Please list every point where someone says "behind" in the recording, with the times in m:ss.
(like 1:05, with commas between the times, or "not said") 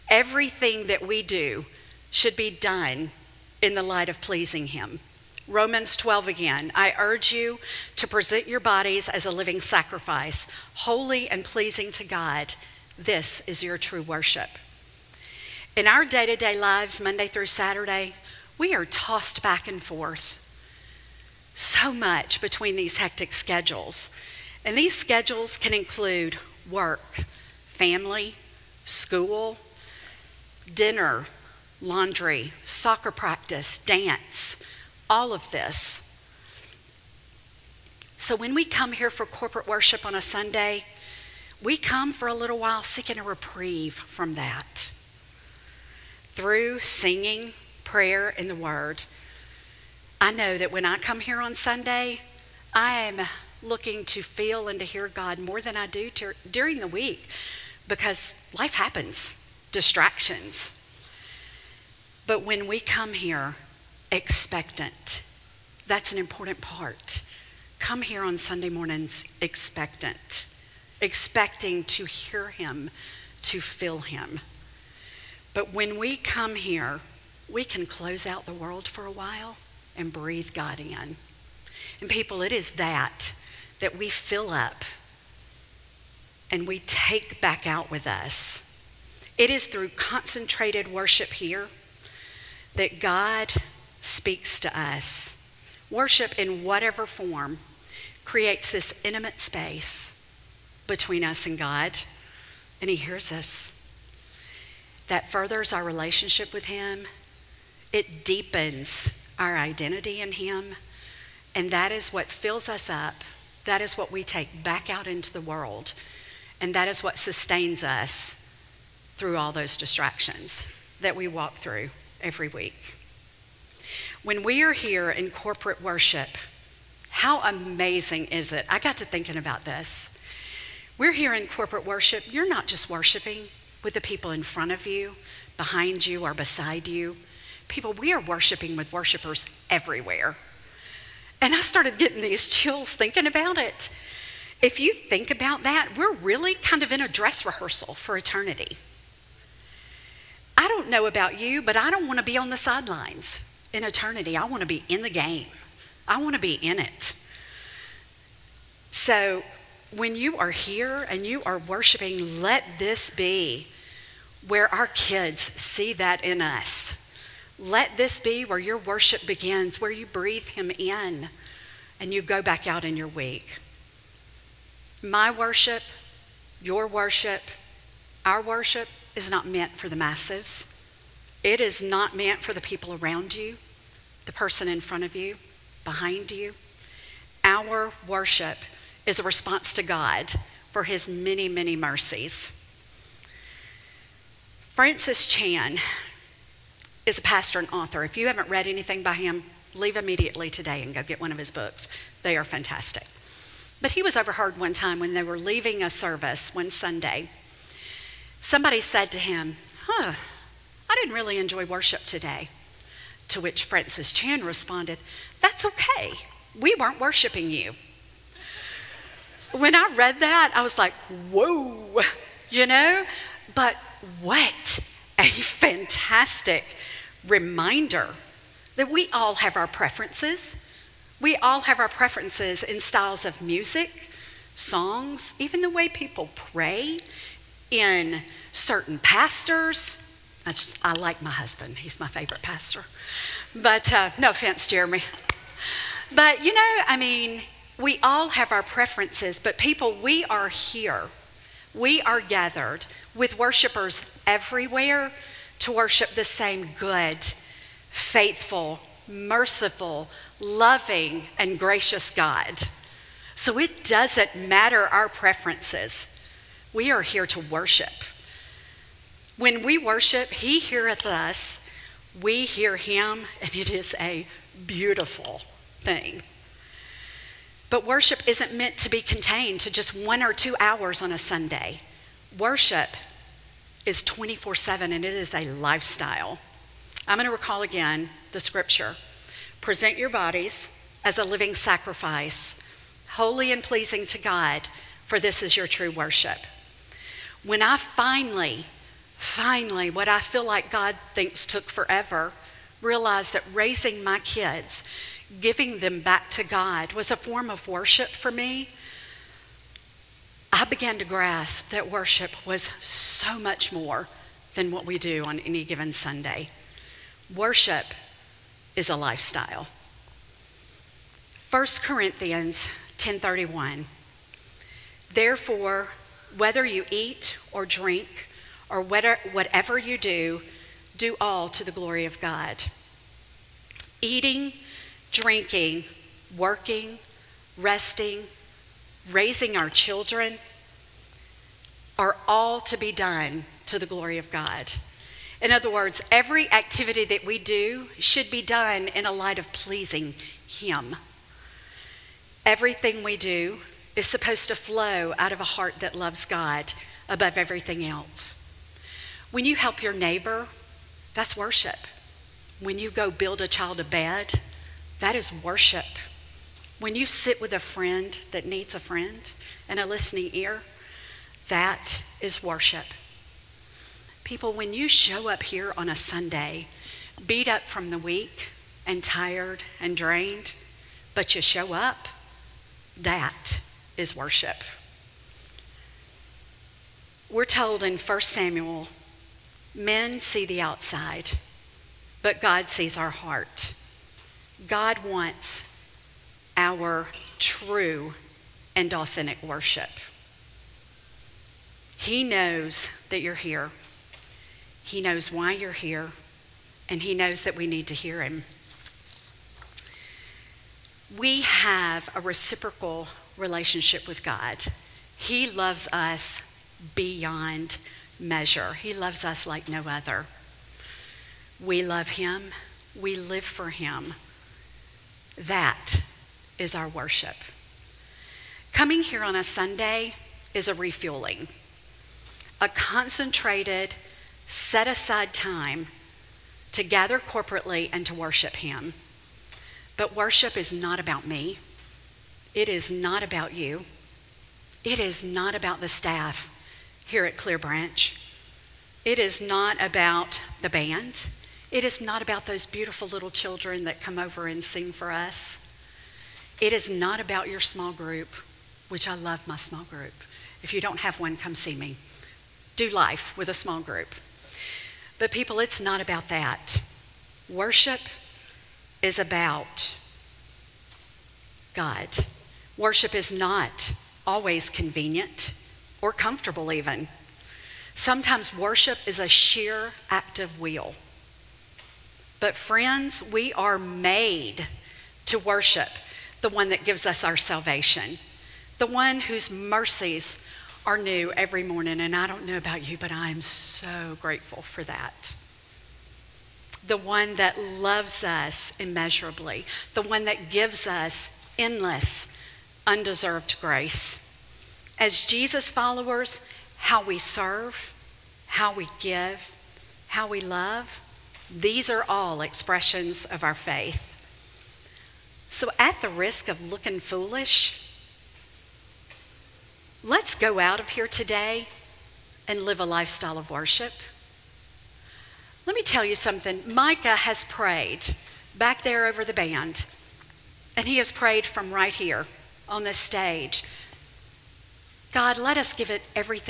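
2:15, 3:05.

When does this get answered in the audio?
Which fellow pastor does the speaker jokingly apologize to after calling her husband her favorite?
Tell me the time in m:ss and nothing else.
4:04.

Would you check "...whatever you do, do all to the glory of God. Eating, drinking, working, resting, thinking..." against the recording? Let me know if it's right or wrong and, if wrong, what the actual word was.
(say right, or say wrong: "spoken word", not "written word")
wrong: "raising", not "thinking".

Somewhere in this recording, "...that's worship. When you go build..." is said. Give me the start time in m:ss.
6:01.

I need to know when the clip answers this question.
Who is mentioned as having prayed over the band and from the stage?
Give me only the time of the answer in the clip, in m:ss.
8:46.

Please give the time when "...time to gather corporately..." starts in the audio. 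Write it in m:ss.
7:15.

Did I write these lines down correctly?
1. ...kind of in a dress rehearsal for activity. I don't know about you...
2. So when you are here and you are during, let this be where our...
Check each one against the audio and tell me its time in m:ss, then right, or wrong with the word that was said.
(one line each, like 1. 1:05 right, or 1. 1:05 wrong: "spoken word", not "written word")
1. 2:26 wrong: "eternity", not "activity"
2. 2:38 wrong: "worshiping", not "during".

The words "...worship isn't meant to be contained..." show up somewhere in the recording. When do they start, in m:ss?
4:37.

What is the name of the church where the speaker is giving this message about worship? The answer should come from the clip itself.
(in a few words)
Clearbranch.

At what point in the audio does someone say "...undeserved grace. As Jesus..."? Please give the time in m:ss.
8:22.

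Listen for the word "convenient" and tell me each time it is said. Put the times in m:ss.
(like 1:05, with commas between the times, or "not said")
7:54.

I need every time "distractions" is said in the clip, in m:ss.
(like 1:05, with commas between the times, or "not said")
0:59, 1:59.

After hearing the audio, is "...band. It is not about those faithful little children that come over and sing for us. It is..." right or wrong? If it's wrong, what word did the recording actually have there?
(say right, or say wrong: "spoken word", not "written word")
wrong: "beautiful", not "faithful".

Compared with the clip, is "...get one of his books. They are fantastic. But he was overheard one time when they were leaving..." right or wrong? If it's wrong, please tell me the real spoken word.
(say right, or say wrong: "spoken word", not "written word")
right.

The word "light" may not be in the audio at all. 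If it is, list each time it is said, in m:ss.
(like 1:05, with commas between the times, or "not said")
0:03, 5:49.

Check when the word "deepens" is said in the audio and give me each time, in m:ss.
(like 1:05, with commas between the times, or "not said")
1:48.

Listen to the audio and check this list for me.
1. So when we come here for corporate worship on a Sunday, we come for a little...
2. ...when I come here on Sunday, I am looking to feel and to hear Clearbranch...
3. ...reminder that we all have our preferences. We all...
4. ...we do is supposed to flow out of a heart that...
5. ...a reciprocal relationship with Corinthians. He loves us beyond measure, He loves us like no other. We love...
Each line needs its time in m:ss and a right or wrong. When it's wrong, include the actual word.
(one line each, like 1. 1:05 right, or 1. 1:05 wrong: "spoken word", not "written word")
1. 0:38 right
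2. 0:50 wrong: "God", not "Clearbranch"
3. 3:47 right
4. 5:53 right
5. 6:52 wrong: "God", not "Corinthians".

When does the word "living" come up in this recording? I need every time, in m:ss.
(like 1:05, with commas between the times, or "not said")
0:09, 4:51.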